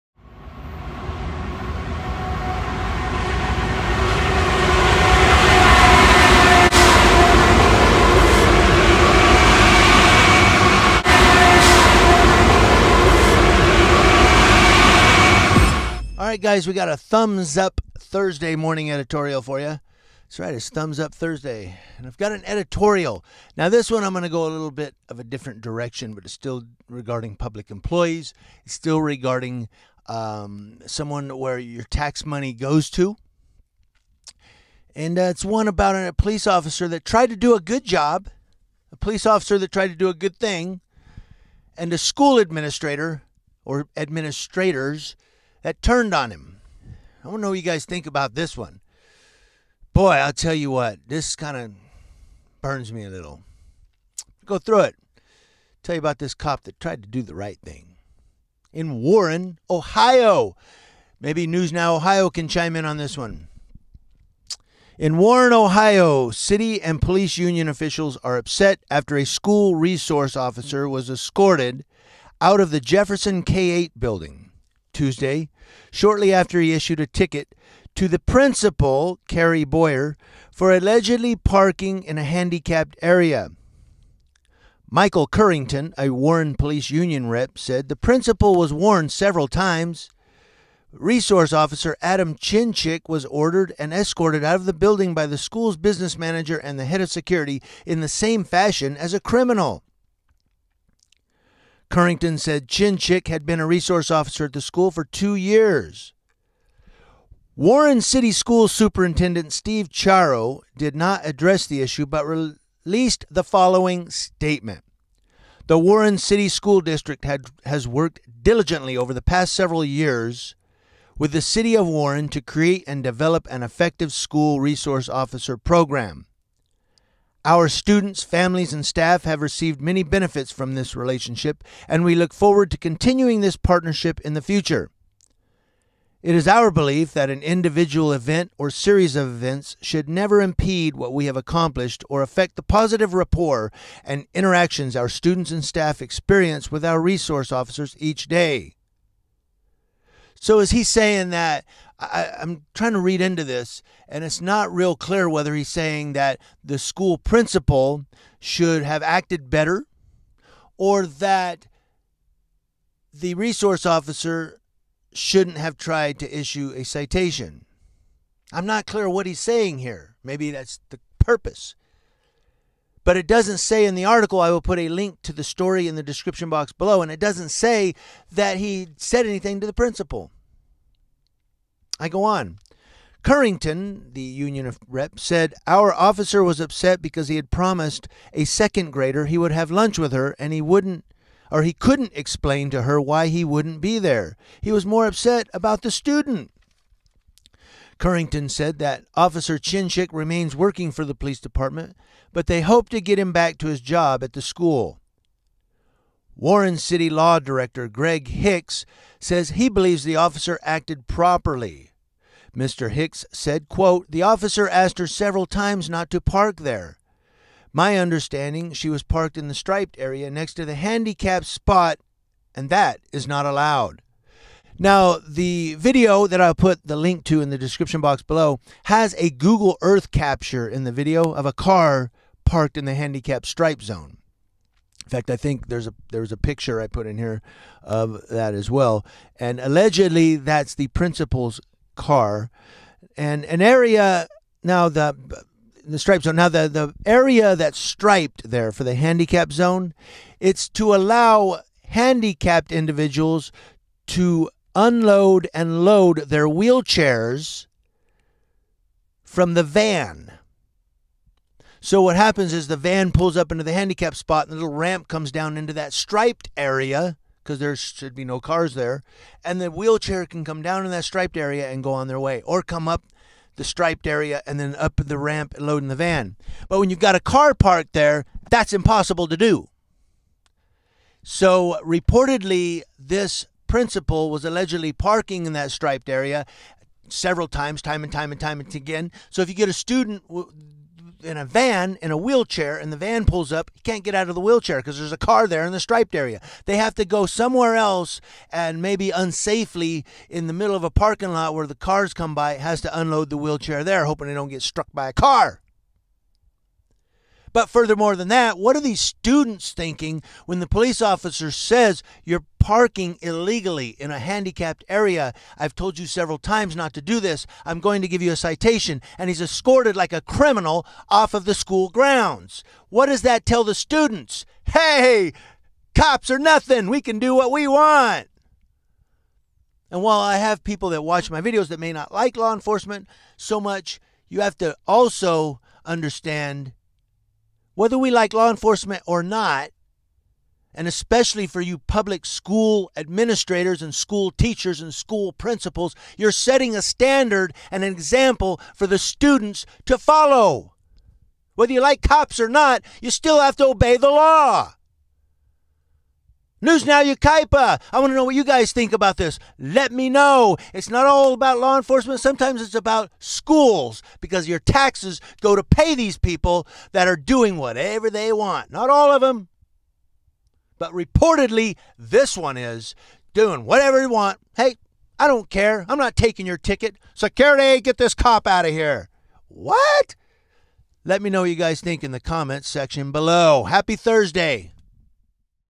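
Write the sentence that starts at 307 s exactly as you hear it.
But furthermore than that, what are these students thinking when the police officer says you're parking illegally in a handicapped area?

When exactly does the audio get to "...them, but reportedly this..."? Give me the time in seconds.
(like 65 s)
369 s.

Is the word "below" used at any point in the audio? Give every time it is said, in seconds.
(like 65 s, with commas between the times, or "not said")
176 s, 228 s, 383 s.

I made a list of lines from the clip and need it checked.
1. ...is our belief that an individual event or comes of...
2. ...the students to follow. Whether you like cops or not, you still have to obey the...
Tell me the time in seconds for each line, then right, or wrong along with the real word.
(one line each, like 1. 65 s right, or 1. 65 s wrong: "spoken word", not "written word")
1. 136 s wrong: "series", not "comes"
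2. 348 s right.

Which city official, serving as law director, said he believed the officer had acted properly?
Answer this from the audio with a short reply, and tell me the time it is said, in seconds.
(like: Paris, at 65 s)
Greg Hicks, at 207 s.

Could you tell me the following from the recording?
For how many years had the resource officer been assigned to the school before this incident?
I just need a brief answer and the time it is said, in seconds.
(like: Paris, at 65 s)
2 years, at 105 s.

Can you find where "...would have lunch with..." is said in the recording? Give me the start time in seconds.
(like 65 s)
189 s.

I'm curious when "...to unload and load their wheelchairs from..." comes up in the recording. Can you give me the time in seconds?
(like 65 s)
254 s.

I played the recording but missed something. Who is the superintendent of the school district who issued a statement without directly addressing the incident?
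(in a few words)
Steve Chiaro.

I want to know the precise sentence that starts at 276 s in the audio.
But when you've got a car parked there, that's impossible to do.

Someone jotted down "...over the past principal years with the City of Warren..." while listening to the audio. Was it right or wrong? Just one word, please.
wrong.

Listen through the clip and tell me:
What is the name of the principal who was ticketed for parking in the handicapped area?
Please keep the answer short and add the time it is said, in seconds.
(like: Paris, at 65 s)
Carrie Boyer, at 79 s.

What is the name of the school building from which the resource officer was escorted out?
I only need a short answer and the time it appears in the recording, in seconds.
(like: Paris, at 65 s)
Jefferson K-8, at 72 s.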